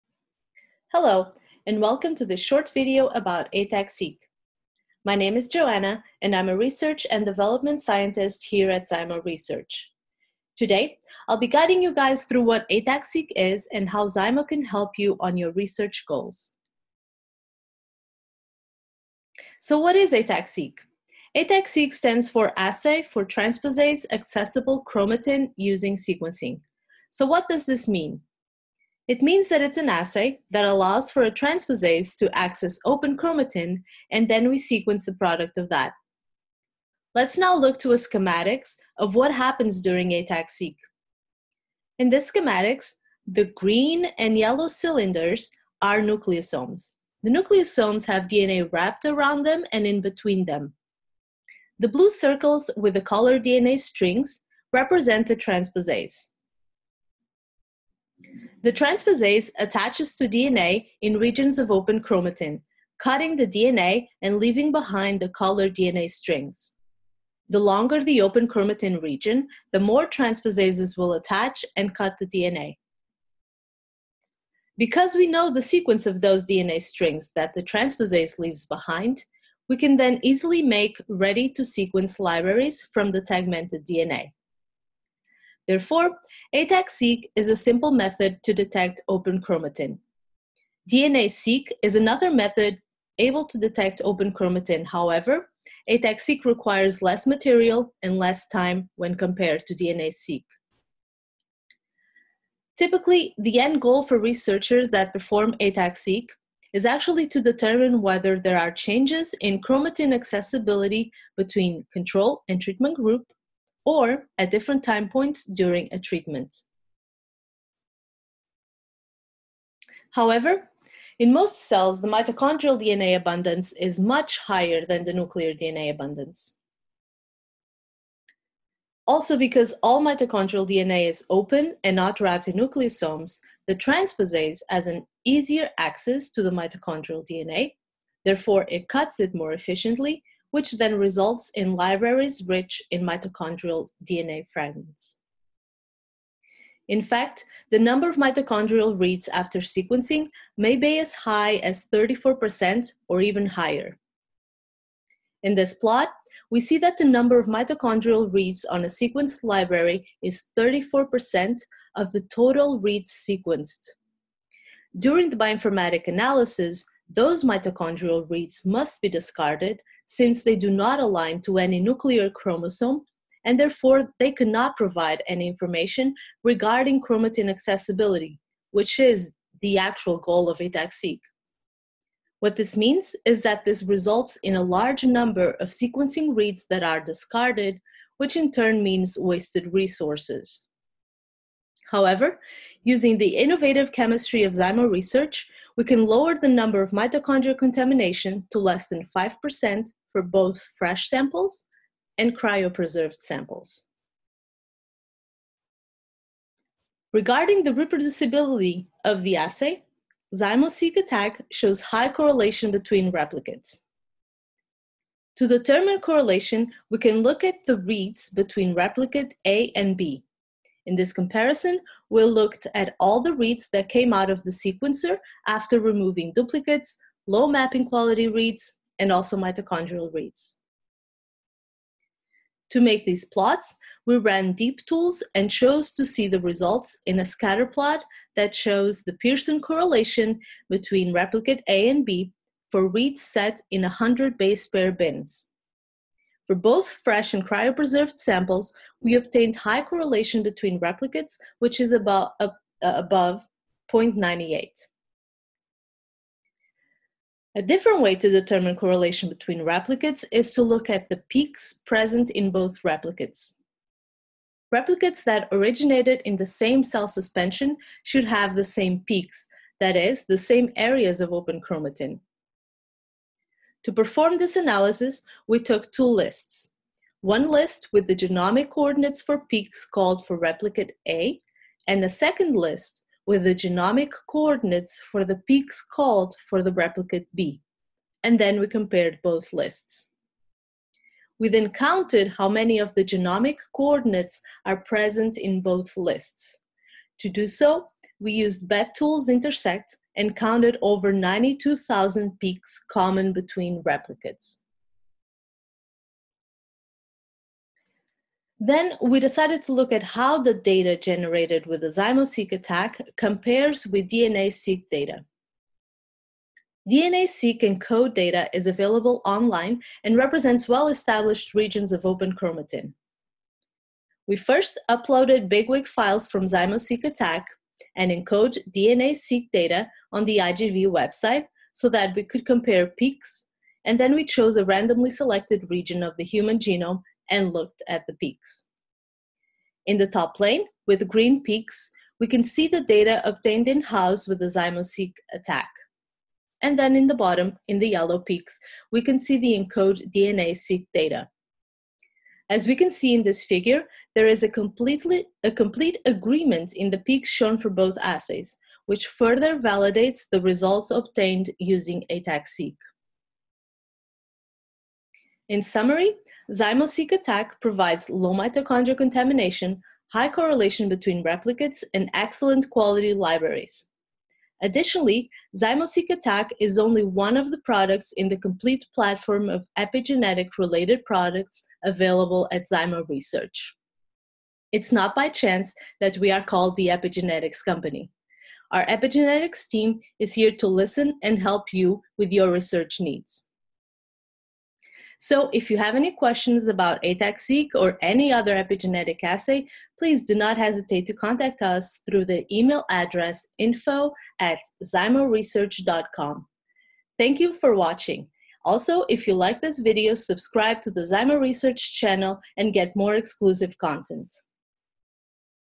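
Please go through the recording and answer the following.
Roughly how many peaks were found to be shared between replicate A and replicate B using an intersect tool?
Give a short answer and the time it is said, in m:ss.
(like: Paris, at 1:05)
over 92,000, at 5:00.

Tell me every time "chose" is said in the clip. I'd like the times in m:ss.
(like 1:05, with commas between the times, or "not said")
3:55, 5:34.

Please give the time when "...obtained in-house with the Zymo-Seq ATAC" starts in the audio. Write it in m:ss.
5:43.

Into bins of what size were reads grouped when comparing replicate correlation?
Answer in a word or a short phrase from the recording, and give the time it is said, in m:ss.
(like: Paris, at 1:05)
100 base pairs, at 4:03.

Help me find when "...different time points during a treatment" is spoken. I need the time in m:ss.
1:54.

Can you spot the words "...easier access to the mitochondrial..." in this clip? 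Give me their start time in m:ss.
2:15.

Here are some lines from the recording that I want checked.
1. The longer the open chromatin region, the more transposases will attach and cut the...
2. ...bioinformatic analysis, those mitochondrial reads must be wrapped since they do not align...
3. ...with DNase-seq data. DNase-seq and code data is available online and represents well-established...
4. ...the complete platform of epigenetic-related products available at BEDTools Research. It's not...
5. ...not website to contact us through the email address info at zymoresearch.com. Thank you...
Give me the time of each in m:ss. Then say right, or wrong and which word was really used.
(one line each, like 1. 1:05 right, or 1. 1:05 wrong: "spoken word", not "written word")
1. 1:07 right
2. 2:45 wrong: "discarded", not "wrapped"
3. 5:13 right
4. 6:18 wrong: "Zymo", not "BEDTools"
5. 6:40 wrong: "hesitate", not "website".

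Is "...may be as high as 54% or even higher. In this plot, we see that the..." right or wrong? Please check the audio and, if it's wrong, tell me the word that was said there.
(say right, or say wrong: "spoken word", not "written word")
wrong: "34", not "54".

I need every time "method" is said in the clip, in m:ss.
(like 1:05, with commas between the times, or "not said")
1:27, 1:32.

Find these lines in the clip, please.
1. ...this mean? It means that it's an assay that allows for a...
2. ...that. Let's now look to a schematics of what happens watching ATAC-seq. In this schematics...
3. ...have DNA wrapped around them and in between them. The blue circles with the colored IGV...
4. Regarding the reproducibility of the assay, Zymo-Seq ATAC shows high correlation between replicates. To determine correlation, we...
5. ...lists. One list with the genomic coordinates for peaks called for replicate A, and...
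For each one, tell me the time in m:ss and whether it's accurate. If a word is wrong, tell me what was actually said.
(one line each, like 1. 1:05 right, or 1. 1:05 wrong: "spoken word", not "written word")
1. 0:27 right
2. 0:35 wrong: "during", not "watching"
3. 0:48 wrong: "DNA", not "IGV"
4. 3:27 right
5. 4:36 right.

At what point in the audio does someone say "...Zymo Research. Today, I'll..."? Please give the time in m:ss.
0:08.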